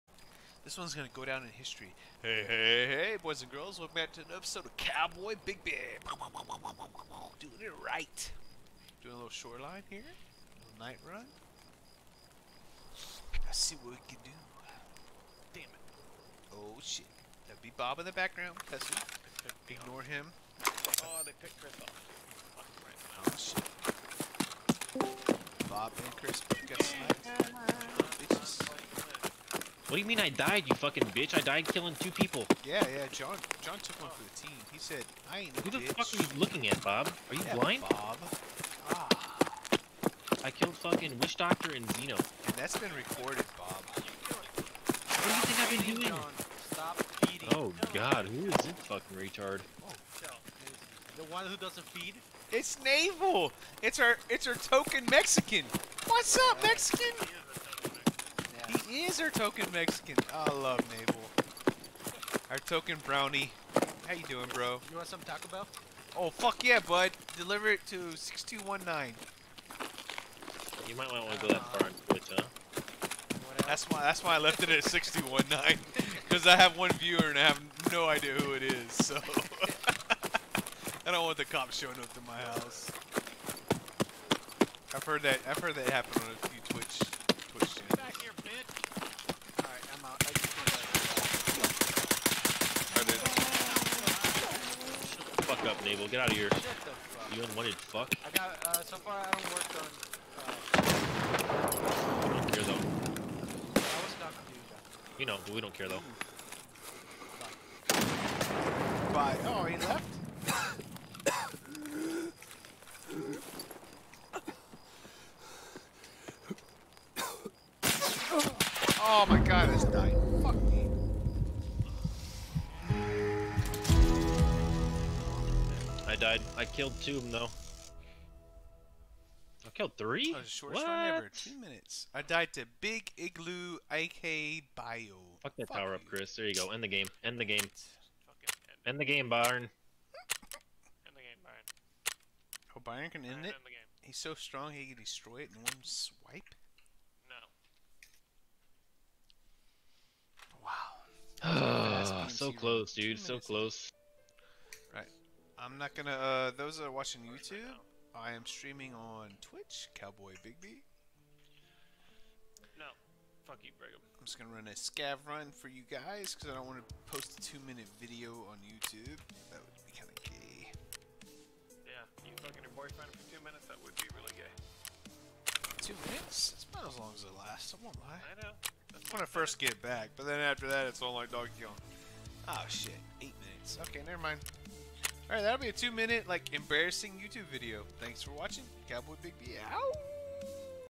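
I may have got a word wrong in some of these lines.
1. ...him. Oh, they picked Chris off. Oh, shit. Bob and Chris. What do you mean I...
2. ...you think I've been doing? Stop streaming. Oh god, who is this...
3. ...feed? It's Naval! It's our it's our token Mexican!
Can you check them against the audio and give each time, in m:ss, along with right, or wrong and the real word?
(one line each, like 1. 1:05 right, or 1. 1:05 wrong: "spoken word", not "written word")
1. 0:20 right
2. 0:45 wrong: "feeding", not "streaming"
3. 0:51 right.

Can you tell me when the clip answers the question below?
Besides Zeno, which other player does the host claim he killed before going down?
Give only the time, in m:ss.
0:41.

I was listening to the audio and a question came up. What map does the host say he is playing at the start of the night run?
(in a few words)
Shoreline.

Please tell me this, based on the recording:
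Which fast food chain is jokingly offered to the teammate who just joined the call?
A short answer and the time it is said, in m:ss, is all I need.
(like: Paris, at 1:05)
Taco Bell, at 1:05.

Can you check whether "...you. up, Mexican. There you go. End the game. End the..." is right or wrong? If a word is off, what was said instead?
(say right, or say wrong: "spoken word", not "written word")
wrong: "Chris", not "Mexican".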